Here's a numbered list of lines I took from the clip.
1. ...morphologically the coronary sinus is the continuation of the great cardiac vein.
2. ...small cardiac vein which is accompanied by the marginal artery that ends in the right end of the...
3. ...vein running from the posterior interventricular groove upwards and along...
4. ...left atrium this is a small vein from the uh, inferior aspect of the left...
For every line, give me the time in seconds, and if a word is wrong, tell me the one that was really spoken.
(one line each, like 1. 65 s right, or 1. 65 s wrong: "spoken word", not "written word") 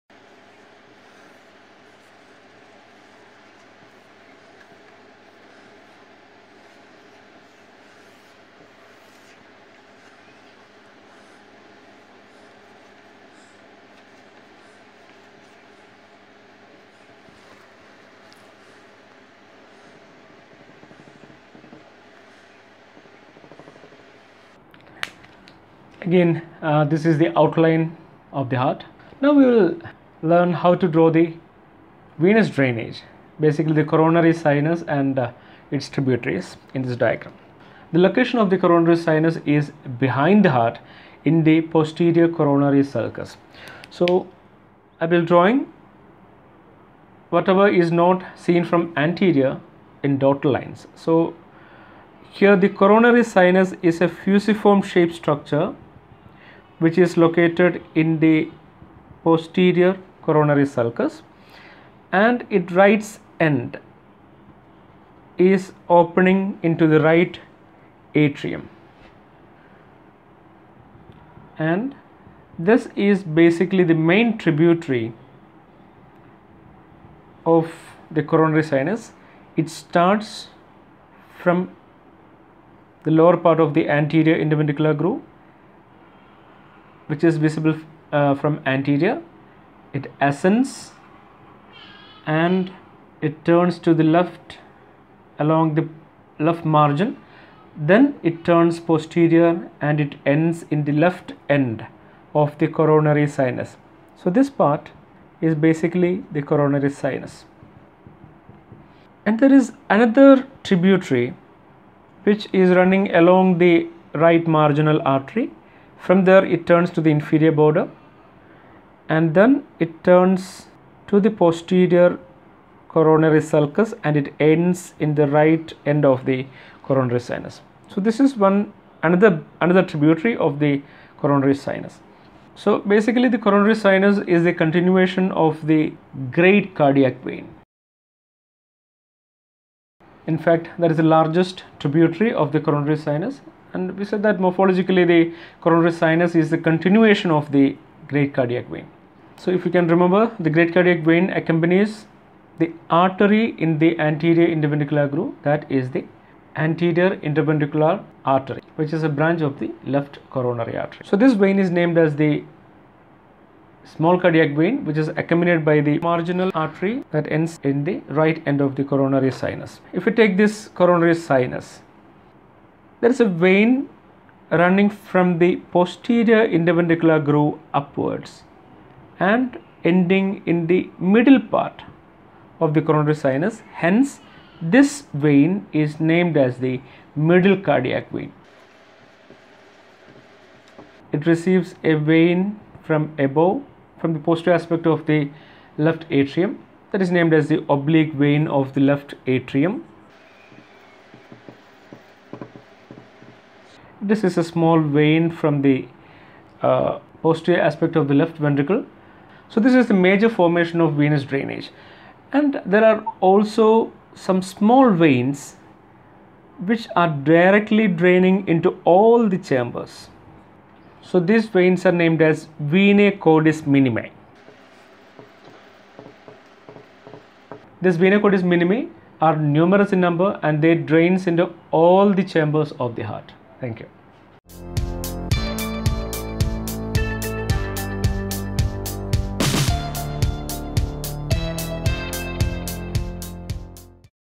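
1. 144 s right
2. 163 s right
3. 173 s wrong: "ending", not "along"
4. 198 s wrong: "posterior", not "inferior".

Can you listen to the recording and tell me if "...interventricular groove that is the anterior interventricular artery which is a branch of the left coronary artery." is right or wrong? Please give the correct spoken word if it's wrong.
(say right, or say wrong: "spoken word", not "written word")
right.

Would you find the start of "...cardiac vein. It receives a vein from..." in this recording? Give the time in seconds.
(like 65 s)
187 s.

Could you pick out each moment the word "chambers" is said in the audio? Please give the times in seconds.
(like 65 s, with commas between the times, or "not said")
219 s, 232 s.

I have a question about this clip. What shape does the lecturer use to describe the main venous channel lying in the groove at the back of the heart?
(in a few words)
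Fusiform.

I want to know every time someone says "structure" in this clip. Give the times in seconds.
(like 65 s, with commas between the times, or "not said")
55 s.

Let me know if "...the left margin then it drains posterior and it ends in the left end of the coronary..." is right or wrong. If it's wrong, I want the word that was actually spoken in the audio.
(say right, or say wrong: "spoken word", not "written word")
wrong: "turns", not "drains".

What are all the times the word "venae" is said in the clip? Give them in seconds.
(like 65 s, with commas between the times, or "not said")
222 s, 228 s.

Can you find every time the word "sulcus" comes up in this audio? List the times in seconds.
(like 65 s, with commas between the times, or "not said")
42 s, 60 s, 123 s.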